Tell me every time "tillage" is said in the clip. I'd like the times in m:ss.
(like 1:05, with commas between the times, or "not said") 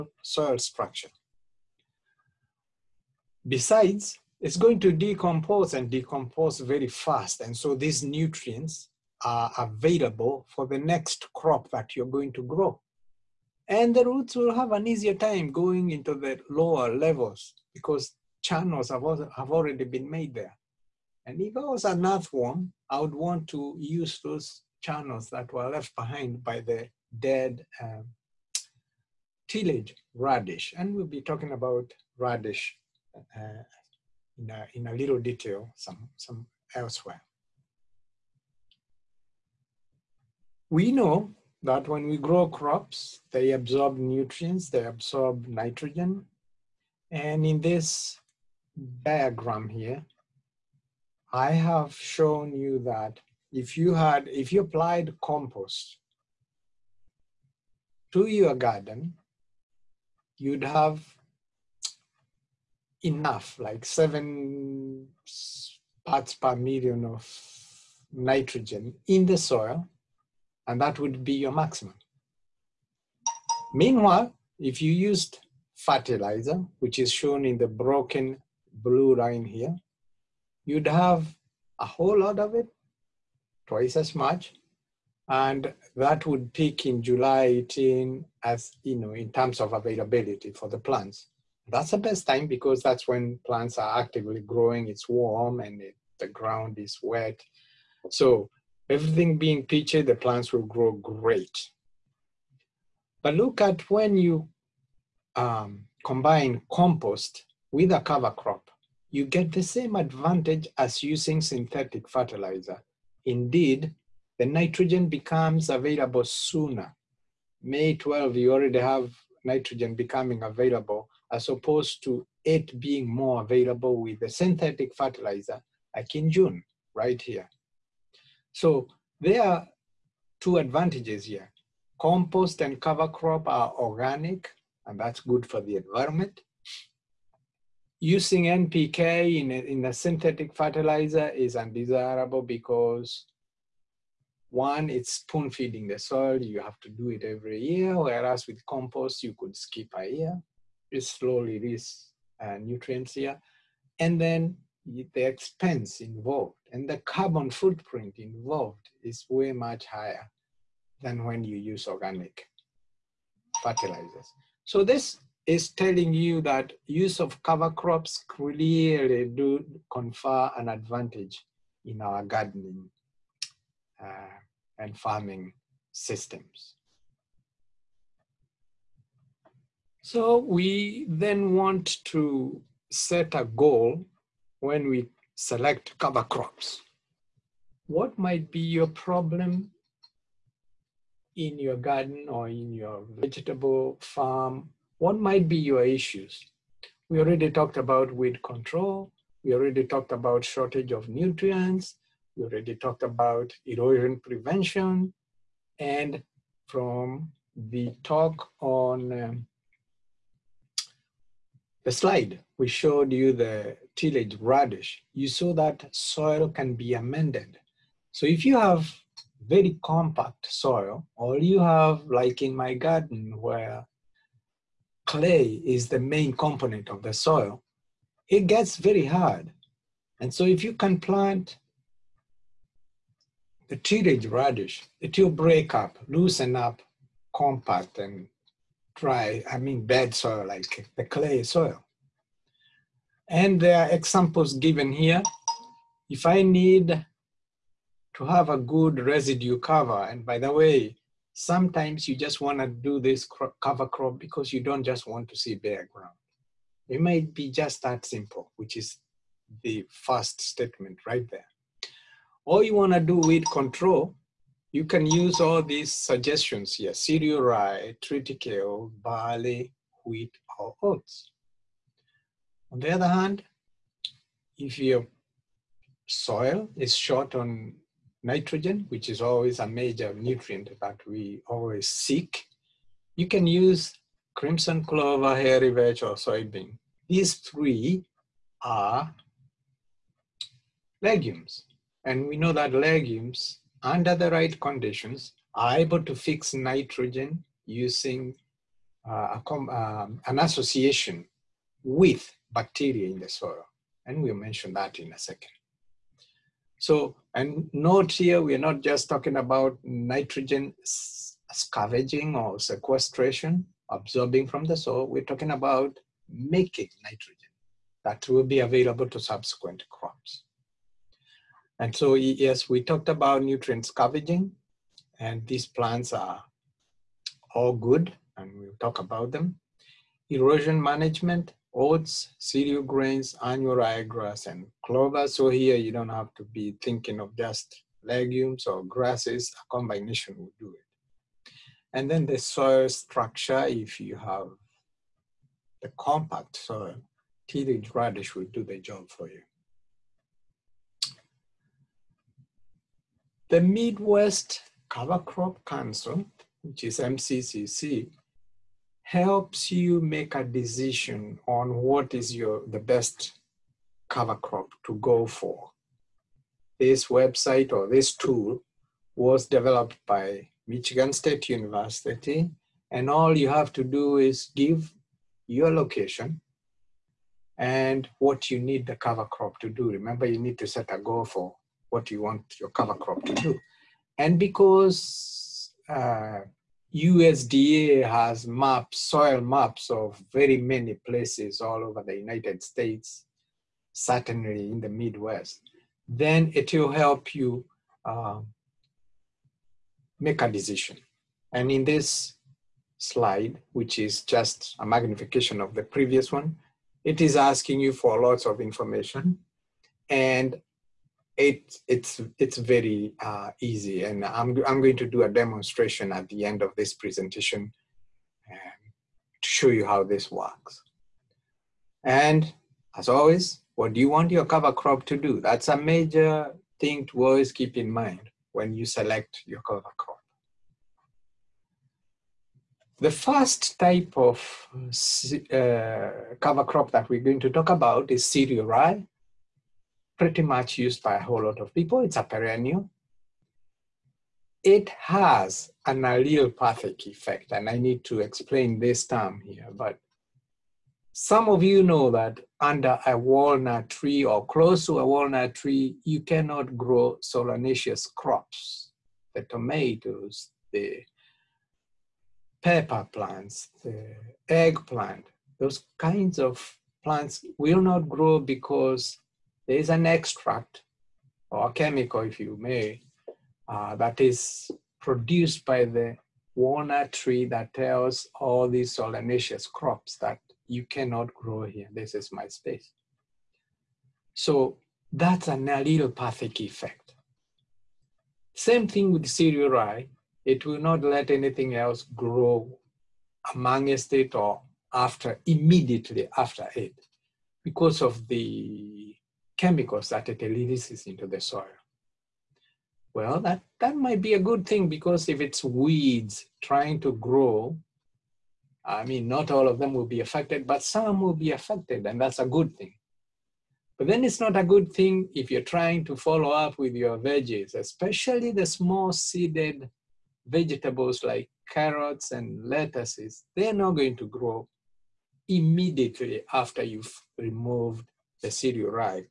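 0:29, 3:33, 3:53, 5:47.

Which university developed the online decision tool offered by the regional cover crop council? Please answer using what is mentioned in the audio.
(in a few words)
Michigan State University.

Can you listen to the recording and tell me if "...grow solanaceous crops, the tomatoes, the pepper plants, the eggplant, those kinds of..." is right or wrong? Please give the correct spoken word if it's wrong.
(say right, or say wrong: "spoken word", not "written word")
right.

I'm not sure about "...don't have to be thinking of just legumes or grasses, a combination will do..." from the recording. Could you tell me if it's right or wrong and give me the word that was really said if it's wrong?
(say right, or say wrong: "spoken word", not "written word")
right.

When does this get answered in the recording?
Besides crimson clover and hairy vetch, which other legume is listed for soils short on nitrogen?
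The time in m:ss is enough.
4:46.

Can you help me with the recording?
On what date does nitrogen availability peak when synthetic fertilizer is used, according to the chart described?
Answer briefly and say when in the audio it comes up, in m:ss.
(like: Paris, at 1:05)
July 18, at 1:27.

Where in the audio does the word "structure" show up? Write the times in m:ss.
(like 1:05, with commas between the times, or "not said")
0:00, 5:42.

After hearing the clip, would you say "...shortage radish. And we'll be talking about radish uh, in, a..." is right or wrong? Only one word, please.
wrong.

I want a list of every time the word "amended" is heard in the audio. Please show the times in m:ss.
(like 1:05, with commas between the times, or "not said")
3:36.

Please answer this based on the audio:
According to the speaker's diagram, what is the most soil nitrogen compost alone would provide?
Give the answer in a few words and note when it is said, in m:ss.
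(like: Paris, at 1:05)
7 parts per million, at 1:03.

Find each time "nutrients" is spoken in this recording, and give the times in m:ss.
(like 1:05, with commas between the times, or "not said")
0:08, 0:43, 2:32, 3:21, 4:40, 5:23.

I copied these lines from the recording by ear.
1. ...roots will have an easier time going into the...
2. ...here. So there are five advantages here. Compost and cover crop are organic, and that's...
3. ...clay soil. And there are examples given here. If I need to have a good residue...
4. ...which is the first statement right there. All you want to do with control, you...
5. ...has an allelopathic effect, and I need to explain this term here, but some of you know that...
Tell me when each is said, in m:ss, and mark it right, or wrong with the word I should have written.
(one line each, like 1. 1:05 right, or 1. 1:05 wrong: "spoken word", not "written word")
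1. 0:14 right
2. 2:07 wrong: "two", not "five"
3. 4:01 right
4. 4:18 right
5. 7:24 right.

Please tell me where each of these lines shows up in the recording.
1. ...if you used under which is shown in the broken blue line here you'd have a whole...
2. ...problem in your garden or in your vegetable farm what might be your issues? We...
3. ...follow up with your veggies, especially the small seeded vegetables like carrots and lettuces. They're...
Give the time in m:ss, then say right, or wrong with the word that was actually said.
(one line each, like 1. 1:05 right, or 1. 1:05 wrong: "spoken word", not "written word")
1. 1:14 wrong: "fertilizer", not "under"
2. 3:08 right
3. 8:36 right.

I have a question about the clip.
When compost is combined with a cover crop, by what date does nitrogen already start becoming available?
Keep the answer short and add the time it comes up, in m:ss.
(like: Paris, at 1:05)
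May 12, at 1:57.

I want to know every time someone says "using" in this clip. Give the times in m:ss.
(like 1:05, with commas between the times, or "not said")
1:51, 2:17, 4:57.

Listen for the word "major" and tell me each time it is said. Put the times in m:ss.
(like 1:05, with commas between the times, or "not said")
4:39, 7:05.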